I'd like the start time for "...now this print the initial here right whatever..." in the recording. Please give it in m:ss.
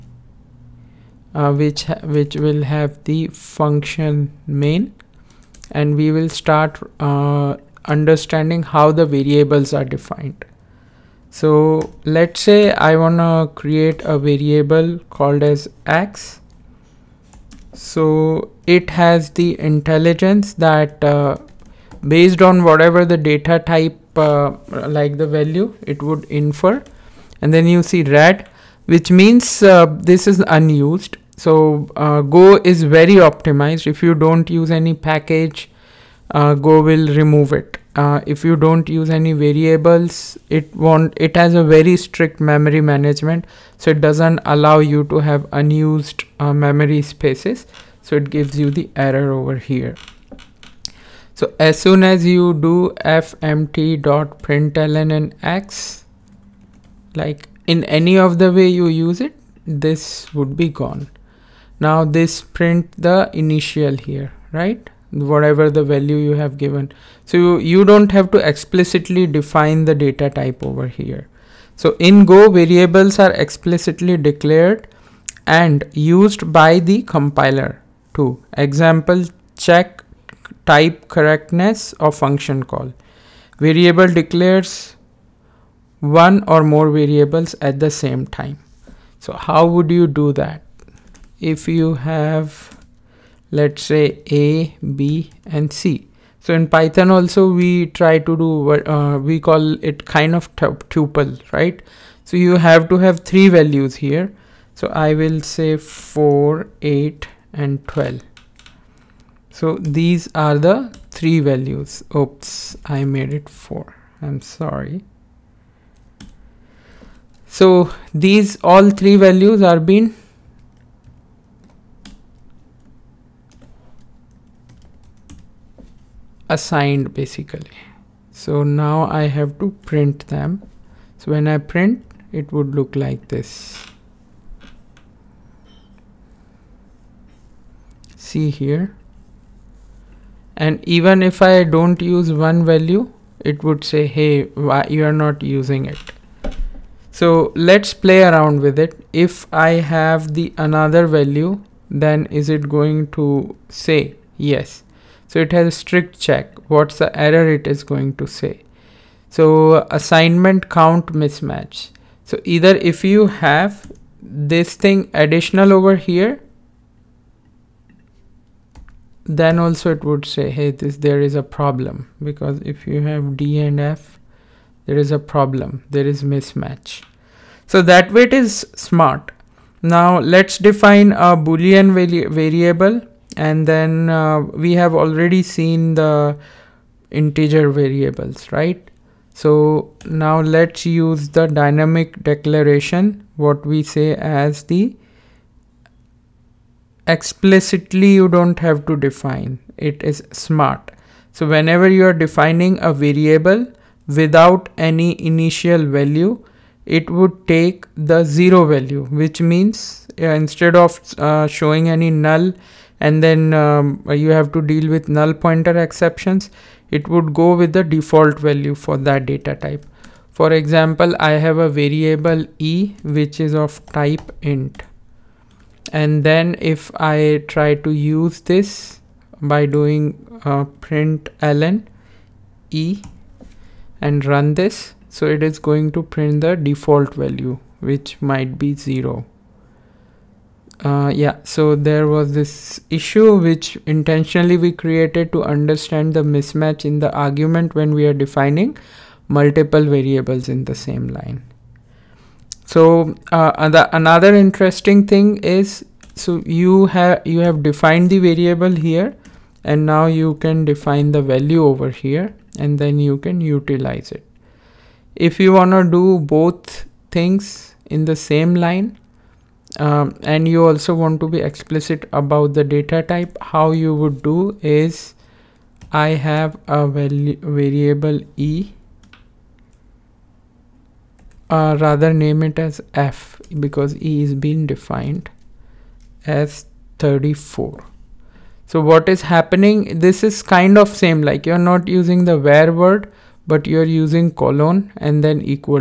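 1:01.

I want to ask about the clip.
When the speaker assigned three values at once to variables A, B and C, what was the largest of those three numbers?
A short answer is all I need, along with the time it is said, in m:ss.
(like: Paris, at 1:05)
12, at 1:47.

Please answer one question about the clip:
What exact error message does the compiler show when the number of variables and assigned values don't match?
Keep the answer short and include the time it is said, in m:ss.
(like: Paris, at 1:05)
assignment count mismatch, at 2:39.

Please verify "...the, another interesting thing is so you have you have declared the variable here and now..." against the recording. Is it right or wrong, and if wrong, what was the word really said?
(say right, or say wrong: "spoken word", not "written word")
wrong: "defined", not "declared".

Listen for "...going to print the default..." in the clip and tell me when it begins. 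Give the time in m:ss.
3:55.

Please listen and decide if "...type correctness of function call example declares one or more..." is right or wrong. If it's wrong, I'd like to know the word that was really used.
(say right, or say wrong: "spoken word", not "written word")
wrong: "variable", not "example".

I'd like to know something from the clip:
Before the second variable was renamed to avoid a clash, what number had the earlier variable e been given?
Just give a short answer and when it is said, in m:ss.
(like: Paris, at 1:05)
34, at 4:46.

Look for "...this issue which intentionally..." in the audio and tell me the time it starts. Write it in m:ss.
4:02.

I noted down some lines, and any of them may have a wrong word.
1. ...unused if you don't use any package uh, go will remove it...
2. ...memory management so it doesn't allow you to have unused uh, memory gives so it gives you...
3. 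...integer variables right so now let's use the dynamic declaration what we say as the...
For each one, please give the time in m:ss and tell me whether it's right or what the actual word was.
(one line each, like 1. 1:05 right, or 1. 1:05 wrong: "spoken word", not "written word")
1. 0:33 wrong: "optimized", not "unused"
2. 0:42 wrong: "spaces", not "gives"
3. 3:07 right.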